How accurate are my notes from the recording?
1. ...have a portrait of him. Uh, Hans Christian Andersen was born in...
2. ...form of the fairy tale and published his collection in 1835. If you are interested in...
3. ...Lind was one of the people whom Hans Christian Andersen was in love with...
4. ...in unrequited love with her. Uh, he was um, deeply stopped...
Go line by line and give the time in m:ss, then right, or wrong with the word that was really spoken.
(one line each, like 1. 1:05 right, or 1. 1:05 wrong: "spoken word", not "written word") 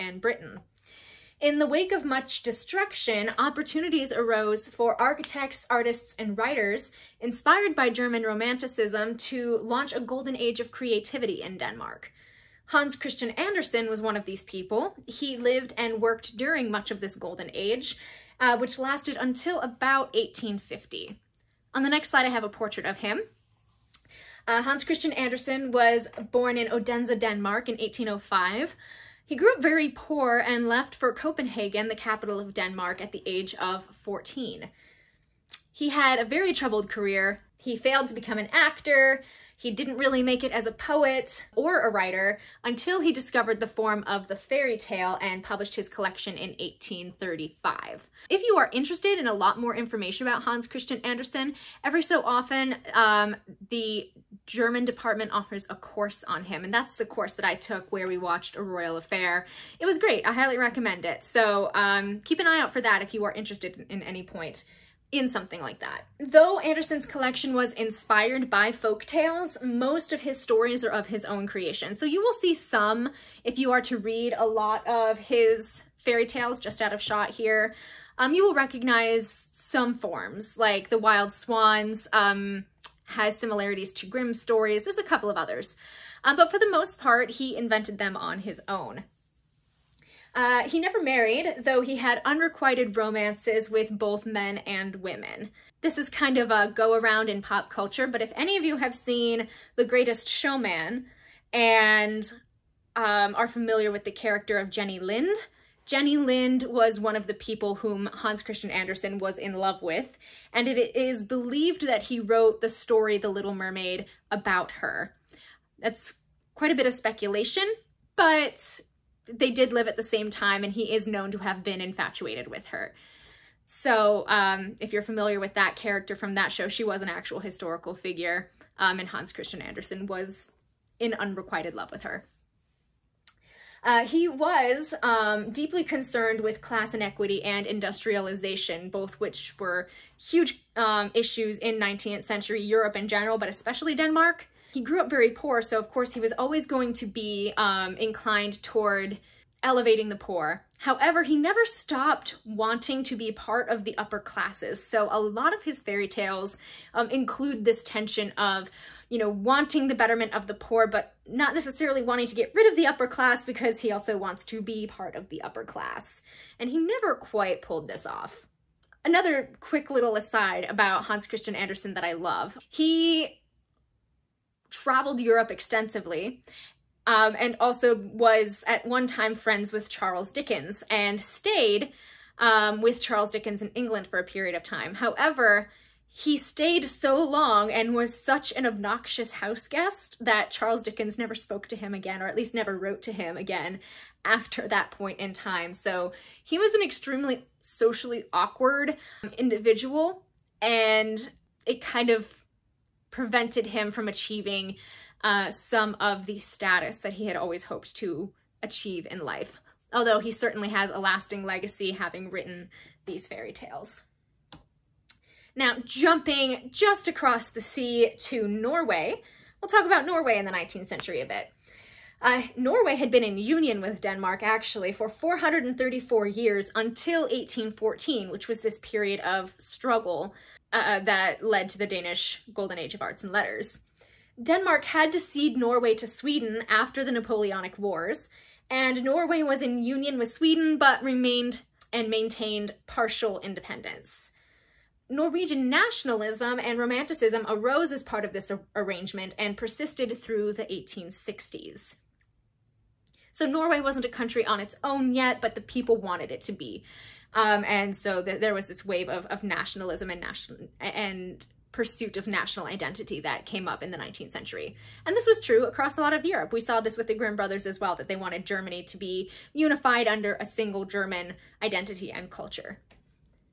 1. 0:22 right
2. 0:43 right
3. 1:46 right
4. 2:10 wrong: "concerned", not "stopped".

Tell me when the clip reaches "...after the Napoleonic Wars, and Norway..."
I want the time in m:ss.
3:56.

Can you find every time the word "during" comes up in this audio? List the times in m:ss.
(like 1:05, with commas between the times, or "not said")
0:16.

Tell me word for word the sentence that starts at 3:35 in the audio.
Now, jumping just across the sea to Norway, we'll talk about Norway in the 19th century a bit.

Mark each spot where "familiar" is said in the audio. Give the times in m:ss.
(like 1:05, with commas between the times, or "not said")
1:43, 2:05.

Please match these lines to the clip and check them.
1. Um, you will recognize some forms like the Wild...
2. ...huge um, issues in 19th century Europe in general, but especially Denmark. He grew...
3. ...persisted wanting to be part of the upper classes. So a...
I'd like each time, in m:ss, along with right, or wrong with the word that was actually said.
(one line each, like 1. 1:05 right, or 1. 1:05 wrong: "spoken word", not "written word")
1. 1:18 right
2. 2:20 right
3. 2:31 wrong: "stopped", not "persisted".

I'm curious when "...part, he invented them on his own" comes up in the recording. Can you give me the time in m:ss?
1:26.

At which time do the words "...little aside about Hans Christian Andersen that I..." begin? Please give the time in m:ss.
2:49.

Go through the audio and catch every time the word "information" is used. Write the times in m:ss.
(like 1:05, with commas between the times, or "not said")
0:49.